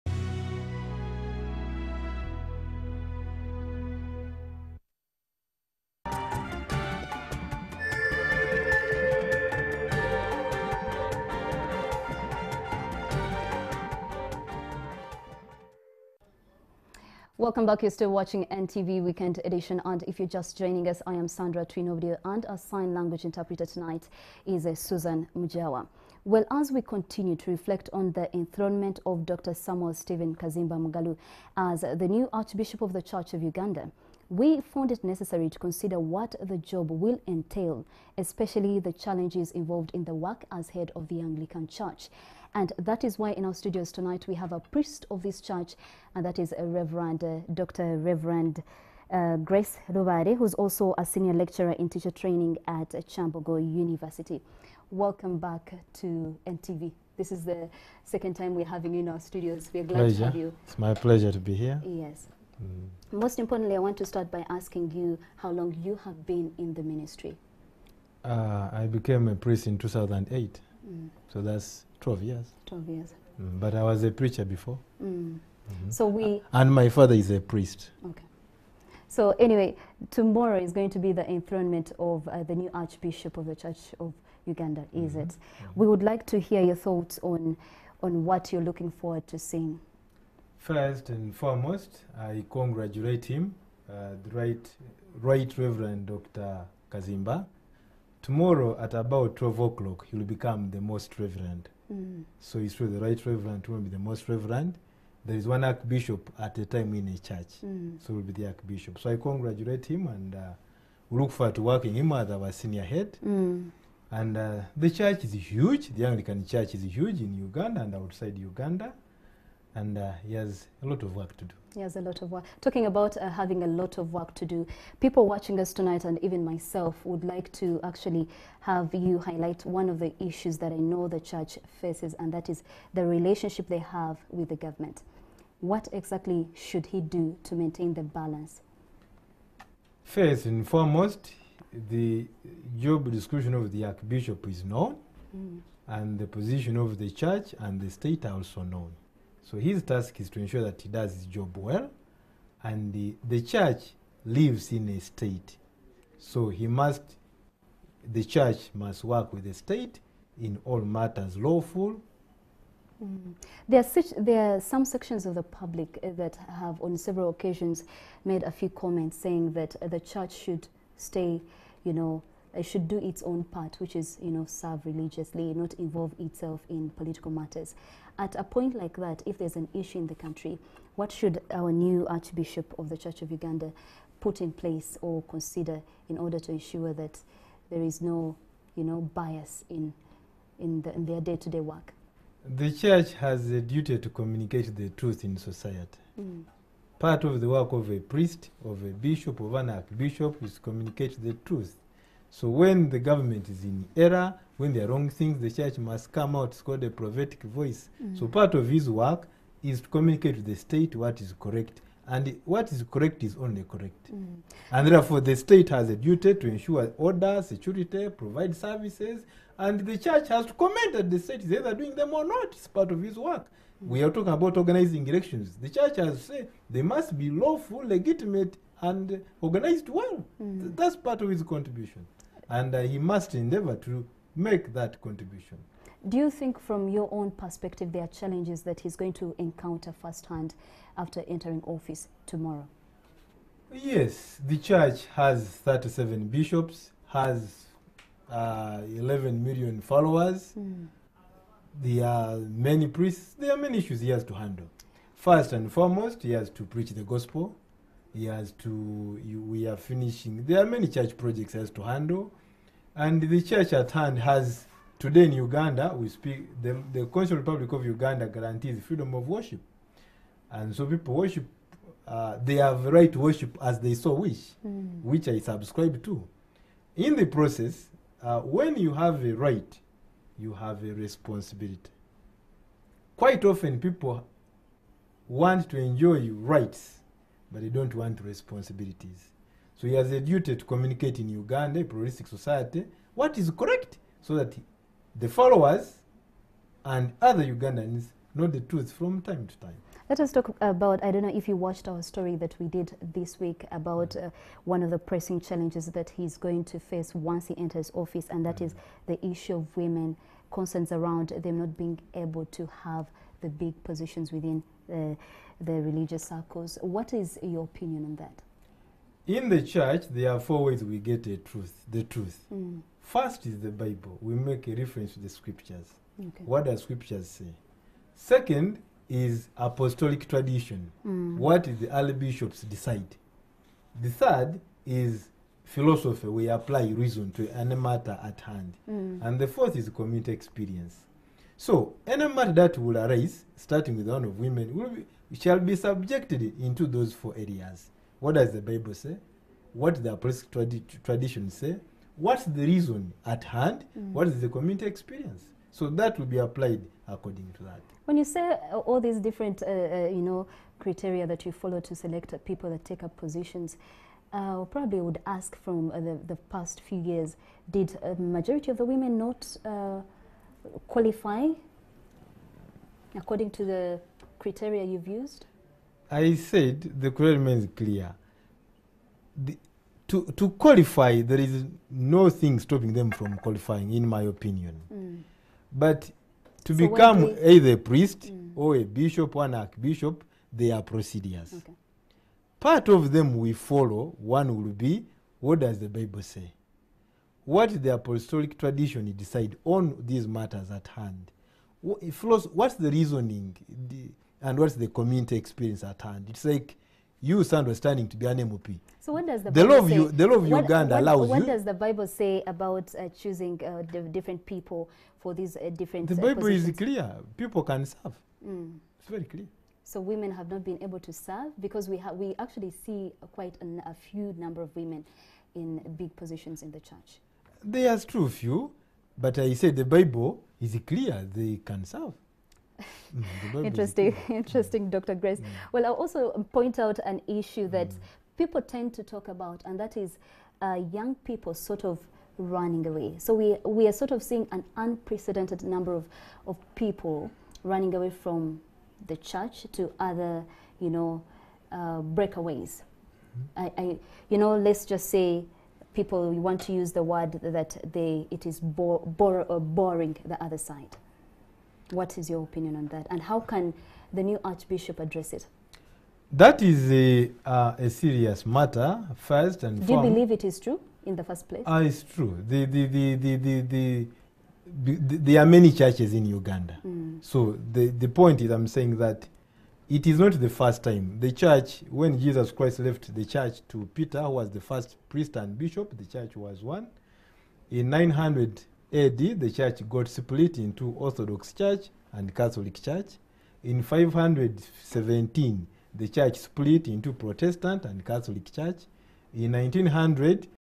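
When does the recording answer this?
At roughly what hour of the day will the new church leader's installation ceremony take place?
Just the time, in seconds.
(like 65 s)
99 s.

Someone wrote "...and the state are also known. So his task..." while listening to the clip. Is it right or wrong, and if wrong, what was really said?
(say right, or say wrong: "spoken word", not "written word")
right.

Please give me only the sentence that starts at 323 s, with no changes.
first is the bible we make a reference to the scriptures okay.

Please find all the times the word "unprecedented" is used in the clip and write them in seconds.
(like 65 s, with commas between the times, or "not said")
444 s.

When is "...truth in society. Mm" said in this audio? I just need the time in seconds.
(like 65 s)
194 s.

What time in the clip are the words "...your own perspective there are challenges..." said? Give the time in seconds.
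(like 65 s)
236 s.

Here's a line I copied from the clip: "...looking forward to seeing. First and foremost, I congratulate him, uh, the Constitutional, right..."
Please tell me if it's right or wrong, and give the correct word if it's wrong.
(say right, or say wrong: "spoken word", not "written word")
wrong: "Right", not "Constitutional".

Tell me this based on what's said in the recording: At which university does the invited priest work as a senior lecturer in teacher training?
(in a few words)
Kyambogo University.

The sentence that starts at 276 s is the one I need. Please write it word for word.
In the process, uh, when you have a right, you have a responsibility.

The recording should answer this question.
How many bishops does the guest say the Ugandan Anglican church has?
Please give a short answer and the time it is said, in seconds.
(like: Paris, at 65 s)
37, at 245 s.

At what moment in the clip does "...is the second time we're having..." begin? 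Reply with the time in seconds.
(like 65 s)
57 s.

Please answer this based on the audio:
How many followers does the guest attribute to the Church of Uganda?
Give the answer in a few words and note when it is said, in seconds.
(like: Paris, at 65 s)
11 million, at 248 s.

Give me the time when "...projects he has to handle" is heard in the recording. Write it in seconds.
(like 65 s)
261 s.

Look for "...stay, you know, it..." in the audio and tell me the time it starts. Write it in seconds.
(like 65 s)
170 s.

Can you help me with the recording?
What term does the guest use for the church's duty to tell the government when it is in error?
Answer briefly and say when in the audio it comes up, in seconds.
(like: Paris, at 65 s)
prophetic voice, at 206 s.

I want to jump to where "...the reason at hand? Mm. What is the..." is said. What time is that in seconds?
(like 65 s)
352 s.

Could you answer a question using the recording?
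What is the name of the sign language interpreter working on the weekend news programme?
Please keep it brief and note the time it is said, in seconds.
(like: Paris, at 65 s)
Susan Mujawa, at 24 s.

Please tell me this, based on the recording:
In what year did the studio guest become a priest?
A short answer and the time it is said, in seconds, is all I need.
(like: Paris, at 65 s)
2008, at 69 s.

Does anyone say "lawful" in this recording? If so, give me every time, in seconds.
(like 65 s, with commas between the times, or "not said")
161 s, 227 s.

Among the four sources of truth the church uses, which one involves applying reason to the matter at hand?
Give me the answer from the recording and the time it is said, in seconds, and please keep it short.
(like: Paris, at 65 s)
philosophy, at 335 s.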